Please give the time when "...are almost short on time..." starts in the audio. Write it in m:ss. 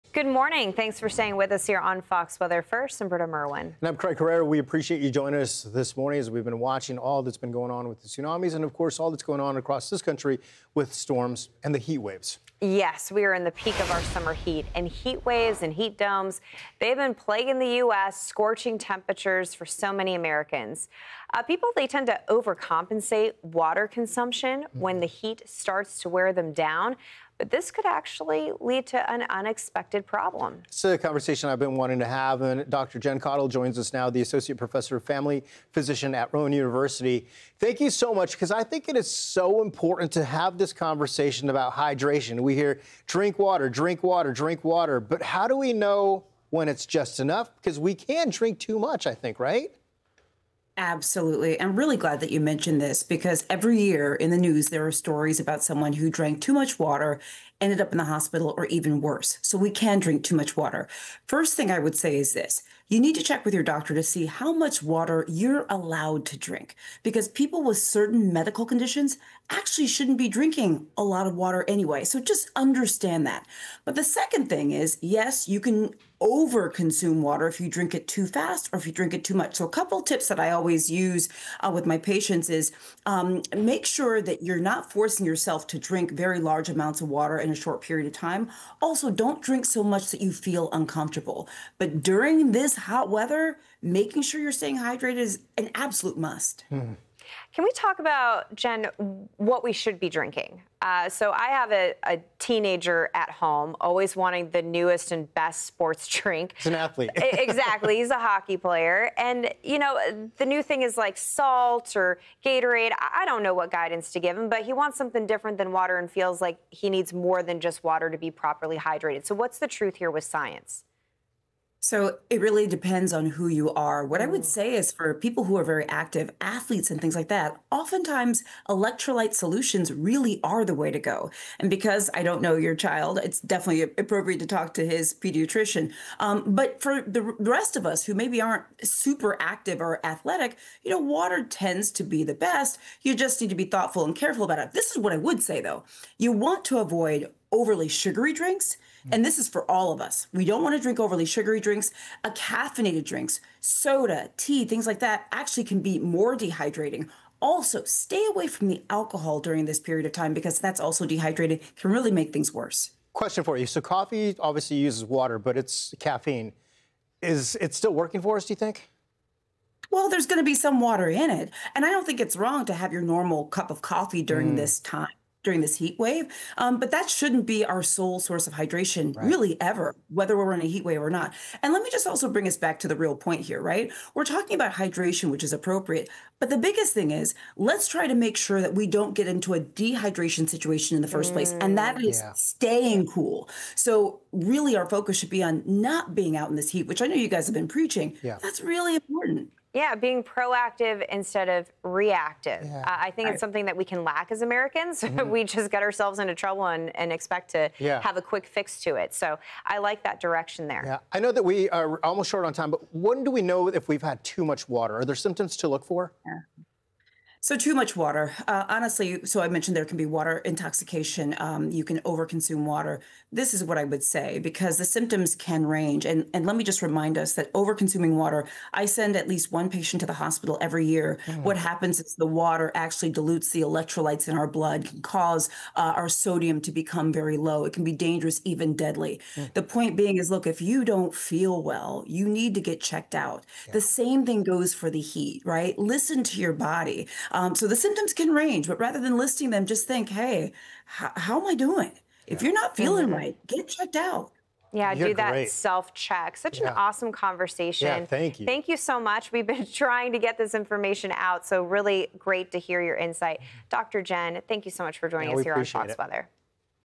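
3:31.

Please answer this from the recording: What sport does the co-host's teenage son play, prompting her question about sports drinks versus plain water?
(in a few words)
Hockey.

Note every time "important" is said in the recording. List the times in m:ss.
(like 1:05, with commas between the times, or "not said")
0:39, 3:18.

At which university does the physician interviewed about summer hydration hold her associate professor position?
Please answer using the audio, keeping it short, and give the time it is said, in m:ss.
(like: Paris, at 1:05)
Rowan University, at 0:36.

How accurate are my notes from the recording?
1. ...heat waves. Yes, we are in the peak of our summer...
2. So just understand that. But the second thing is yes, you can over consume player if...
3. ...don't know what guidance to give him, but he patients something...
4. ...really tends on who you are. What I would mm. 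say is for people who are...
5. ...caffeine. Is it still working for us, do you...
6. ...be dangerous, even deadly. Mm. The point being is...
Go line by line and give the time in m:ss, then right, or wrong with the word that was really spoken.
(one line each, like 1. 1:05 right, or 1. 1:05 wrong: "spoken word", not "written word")
1. 0:11 right
2. 1:12 wrong: "water", not "player"
3. 1:53 wrong: "wants", not "patients"
4. 2:02 wrong: "depends", not "tends"
5. 2:45 right
6. 3:57 right.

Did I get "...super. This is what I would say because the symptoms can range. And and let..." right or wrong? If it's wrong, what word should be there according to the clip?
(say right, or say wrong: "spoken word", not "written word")
wrong: "water", not "super".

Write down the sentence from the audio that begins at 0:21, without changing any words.
Uh, people, they tend to overcompensate water consumption when mm-hmm.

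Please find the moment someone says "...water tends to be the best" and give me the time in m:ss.
2:20.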